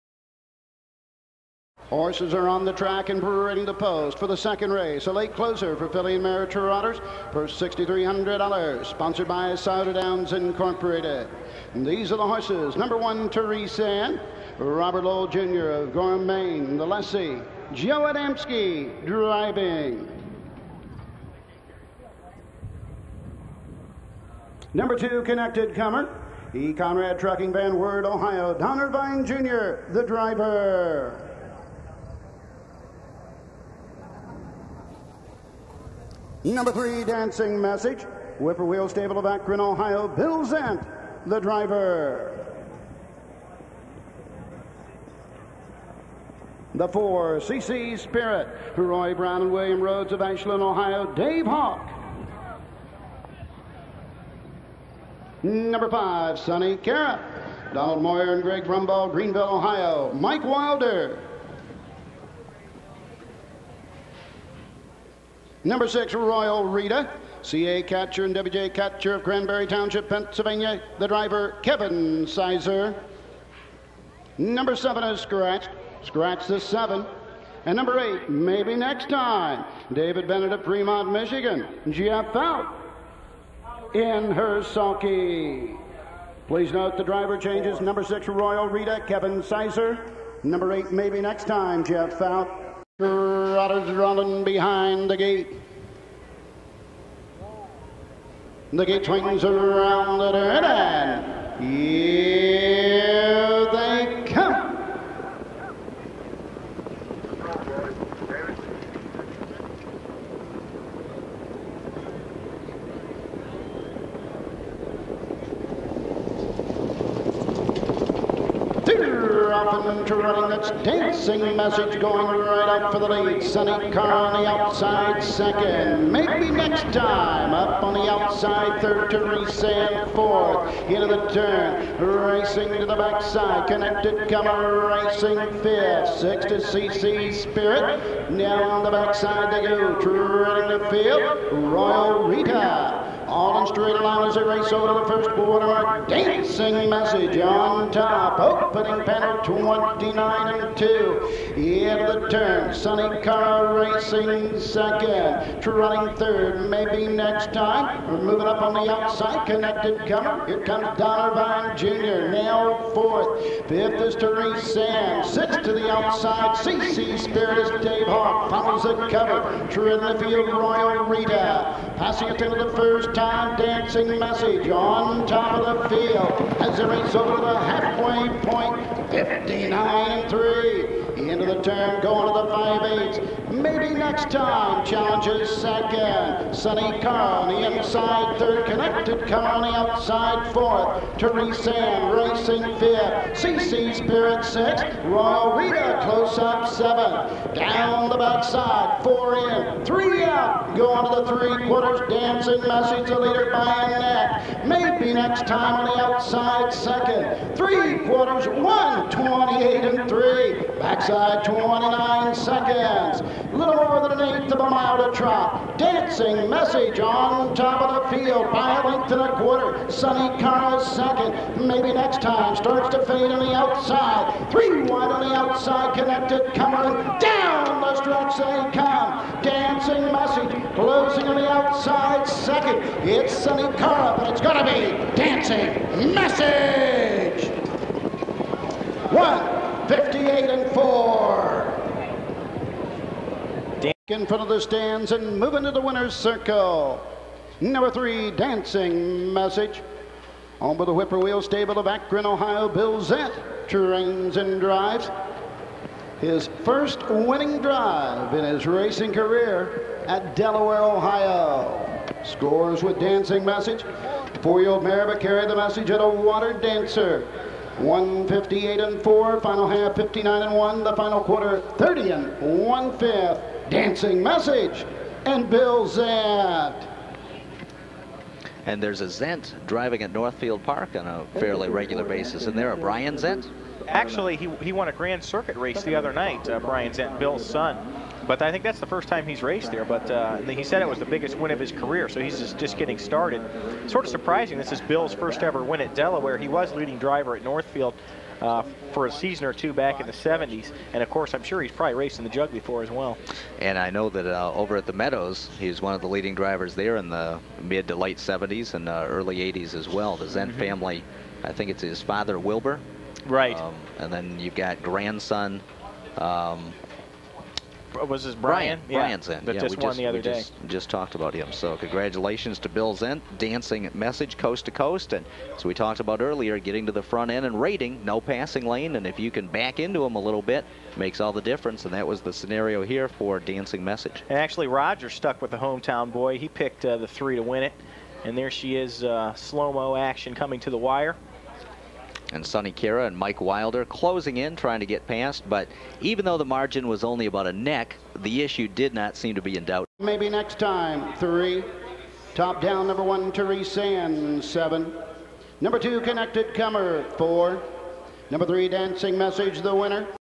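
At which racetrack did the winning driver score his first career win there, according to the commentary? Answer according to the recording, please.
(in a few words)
Delaware, Ohio.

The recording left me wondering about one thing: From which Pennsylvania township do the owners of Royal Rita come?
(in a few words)
Cranberry Township.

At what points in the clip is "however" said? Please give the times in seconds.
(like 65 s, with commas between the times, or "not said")
not said.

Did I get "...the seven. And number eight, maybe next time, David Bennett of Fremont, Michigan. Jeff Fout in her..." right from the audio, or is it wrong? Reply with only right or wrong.
right.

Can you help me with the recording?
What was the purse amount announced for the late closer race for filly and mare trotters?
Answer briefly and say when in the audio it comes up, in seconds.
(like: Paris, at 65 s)
$6,300, at 7 s.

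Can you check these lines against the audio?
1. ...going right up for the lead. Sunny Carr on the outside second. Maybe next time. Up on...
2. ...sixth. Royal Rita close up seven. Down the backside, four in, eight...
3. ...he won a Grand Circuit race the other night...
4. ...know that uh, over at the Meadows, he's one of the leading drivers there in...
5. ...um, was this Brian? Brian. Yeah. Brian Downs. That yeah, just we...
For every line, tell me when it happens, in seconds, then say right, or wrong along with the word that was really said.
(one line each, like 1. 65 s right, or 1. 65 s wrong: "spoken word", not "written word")
1. 122 s right
2. 194 s wrong: "three", not "eight"
3. 284 s right
4. 303 s right
5. 316 s wrong: "Zendt", not "Downs".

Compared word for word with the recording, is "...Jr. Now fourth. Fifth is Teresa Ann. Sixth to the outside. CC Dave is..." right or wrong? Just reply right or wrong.
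wrong.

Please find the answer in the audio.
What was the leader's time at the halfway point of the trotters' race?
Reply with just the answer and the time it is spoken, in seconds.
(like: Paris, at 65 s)
59 3, at 179 s.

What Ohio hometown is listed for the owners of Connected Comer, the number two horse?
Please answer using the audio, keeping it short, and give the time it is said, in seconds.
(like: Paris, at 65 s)
Van Wert, Ohio, at 27 s.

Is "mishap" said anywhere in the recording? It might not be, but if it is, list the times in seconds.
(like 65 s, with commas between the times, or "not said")
not said.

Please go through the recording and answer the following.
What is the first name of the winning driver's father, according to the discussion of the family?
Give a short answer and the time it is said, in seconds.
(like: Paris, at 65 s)
Wilbur, at 312 s.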